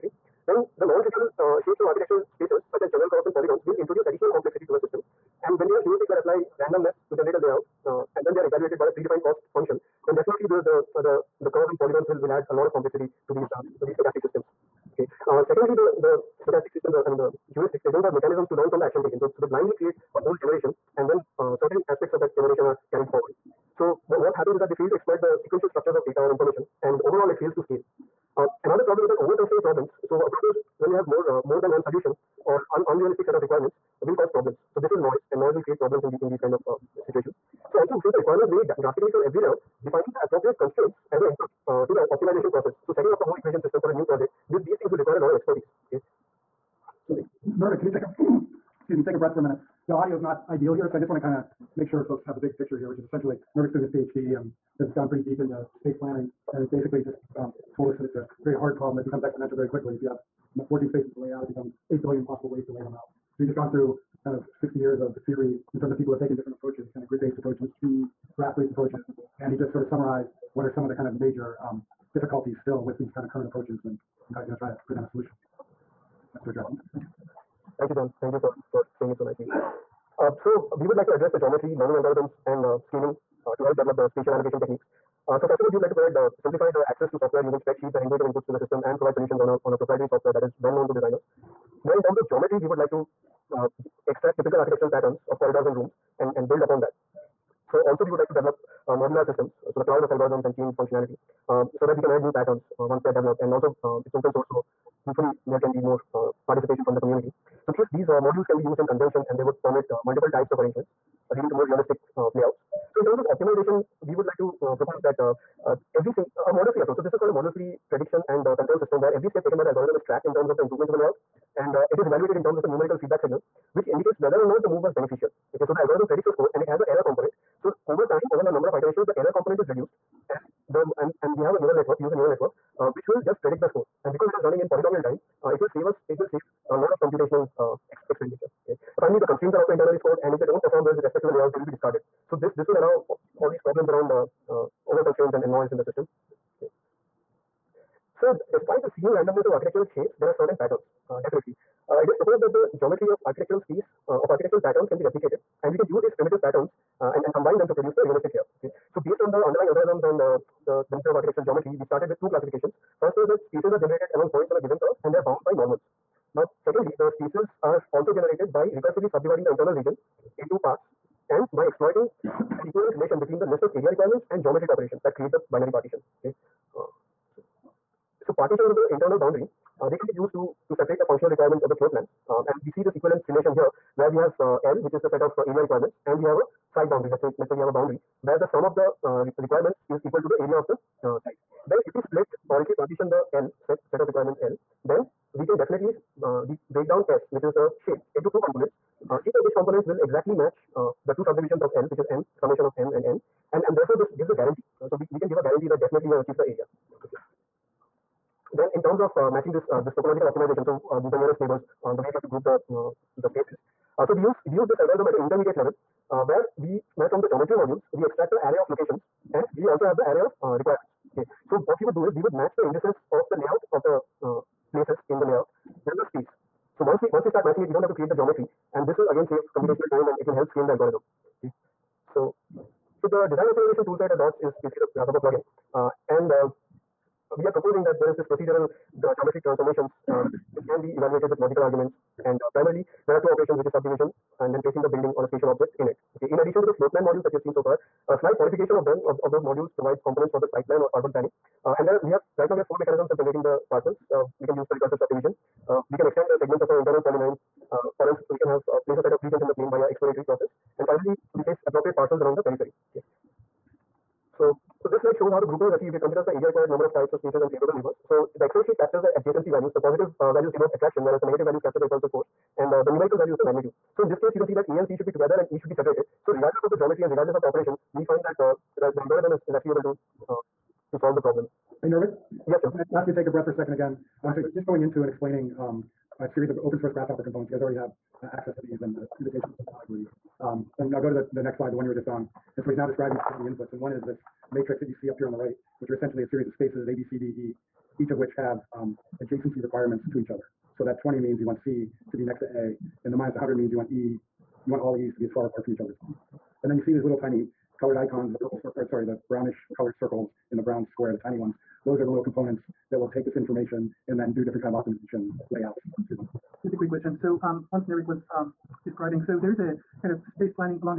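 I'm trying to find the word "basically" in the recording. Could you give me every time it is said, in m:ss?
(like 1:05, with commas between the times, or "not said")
0:56, 3:54.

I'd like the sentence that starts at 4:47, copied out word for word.
You guys already have uh, access to these and uh, invitations.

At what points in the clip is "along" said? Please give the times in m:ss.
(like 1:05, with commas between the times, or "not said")
2:44, 4:22.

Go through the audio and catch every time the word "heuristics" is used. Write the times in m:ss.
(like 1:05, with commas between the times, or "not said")
0:05, 0:17.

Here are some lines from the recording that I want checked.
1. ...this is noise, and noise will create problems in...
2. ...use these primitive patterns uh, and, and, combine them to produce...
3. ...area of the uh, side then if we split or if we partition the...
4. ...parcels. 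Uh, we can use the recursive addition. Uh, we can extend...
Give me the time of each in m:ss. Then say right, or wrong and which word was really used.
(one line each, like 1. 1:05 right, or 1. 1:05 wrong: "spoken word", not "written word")
1. 0:34 right
2. 2:35 right
3. 3:10 right
4. 4:13 wrong: "subdivision", not "addition".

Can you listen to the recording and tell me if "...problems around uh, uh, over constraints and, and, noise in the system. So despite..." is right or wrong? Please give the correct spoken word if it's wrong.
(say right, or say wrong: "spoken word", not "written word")
right.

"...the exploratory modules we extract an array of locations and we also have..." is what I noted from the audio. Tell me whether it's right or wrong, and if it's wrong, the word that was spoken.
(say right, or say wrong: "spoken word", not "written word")
wrong: "geometry", not "exploratory".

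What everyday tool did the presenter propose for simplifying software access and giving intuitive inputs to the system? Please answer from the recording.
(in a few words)
Spreadsheets.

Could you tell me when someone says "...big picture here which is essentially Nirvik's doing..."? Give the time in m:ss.
0:52.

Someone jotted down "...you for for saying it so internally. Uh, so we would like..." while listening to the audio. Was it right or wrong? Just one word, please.
wrong.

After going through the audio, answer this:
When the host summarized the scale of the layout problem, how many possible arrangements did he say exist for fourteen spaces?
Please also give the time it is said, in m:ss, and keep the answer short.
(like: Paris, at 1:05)
8 billion, at 1:01.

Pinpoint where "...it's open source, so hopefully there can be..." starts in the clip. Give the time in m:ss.
1:44.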